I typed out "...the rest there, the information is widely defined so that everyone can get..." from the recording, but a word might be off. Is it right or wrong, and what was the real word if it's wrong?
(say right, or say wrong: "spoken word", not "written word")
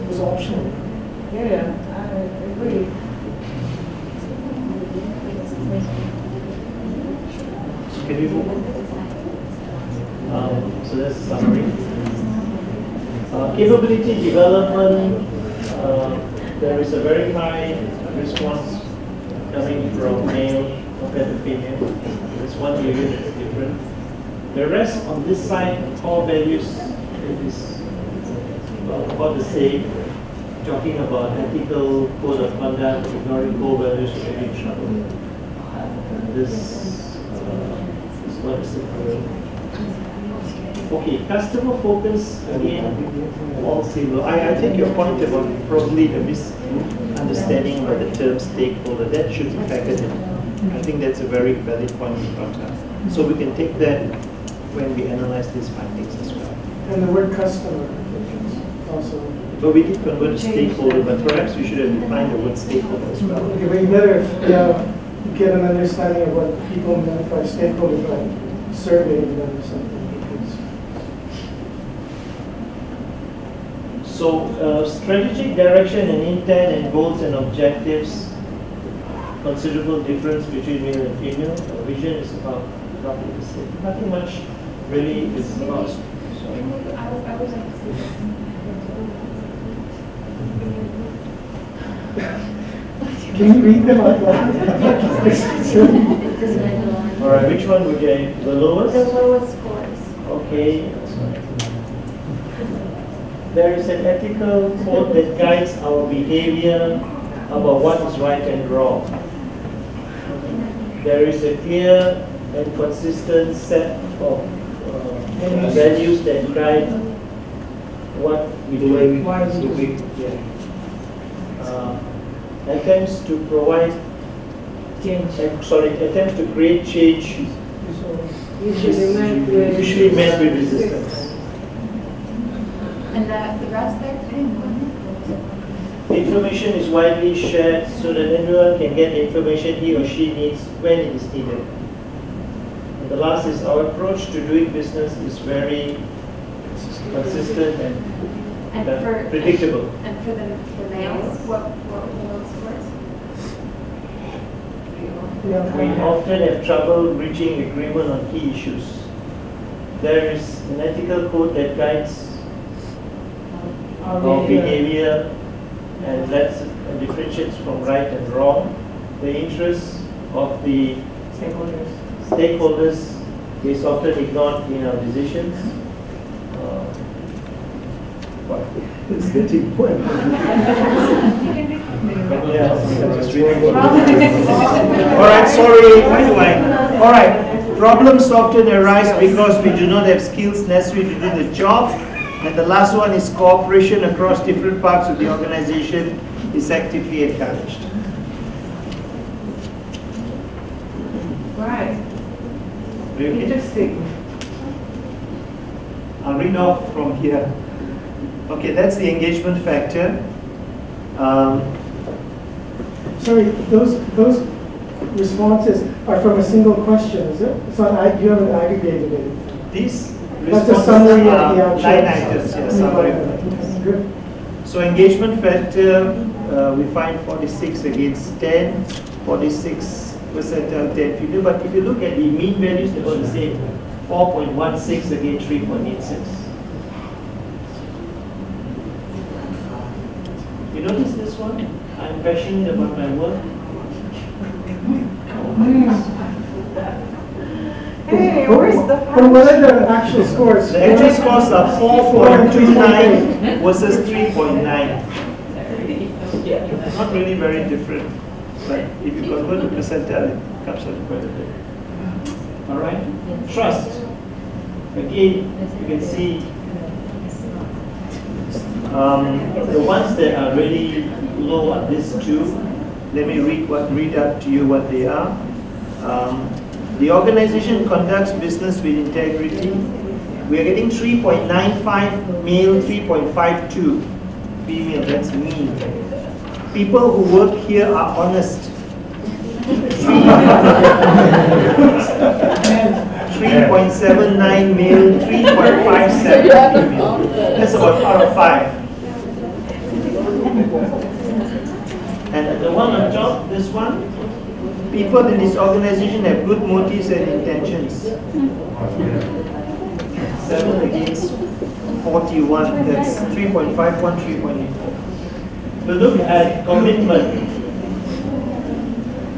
wrong: "shared", not "defined".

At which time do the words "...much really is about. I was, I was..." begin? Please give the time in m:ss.
1:24.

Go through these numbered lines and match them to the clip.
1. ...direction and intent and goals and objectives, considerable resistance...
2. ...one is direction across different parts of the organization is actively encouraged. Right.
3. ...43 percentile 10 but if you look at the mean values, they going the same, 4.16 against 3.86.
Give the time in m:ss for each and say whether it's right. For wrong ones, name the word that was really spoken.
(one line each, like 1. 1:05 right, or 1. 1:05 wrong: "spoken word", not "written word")
1. 1:15 wrong: "difference", not "resistance"
2. 3:12 wrong: "cooperation", not "direction"
3. 3:48 wrong: "46", not "43".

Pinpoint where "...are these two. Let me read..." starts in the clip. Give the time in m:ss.
4:31.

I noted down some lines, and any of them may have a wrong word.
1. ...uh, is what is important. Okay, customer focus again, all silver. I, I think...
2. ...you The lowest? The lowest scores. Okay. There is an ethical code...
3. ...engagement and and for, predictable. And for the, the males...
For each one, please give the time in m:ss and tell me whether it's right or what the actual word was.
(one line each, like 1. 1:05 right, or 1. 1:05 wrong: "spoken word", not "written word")
1. 0:37 right
2. 1:37 right
3. 2:27 wrong: "consistent", not "engagement".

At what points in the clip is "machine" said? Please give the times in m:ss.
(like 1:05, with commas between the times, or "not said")
not said.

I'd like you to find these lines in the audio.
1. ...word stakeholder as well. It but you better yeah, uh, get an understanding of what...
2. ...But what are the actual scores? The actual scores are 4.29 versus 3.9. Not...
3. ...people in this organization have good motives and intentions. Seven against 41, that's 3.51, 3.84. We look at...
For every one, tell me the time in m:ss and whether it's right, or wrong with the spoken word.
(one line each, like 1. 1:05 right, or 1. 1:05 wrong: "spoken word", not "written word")
1. 1:02 right
2. 4:09 right
3. 5:04 right.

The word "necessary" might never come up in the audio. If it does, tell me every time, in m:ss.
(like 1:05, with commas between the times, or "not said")
3:10.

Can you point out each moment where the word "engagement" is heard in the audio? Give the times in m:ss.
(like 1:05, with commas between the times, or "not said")
3:29, 3:44.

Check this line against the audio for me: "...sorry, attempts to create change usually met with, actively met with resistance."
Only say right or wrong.
wrong.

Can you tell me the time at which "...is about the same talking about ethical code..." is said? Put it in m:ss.
0:27.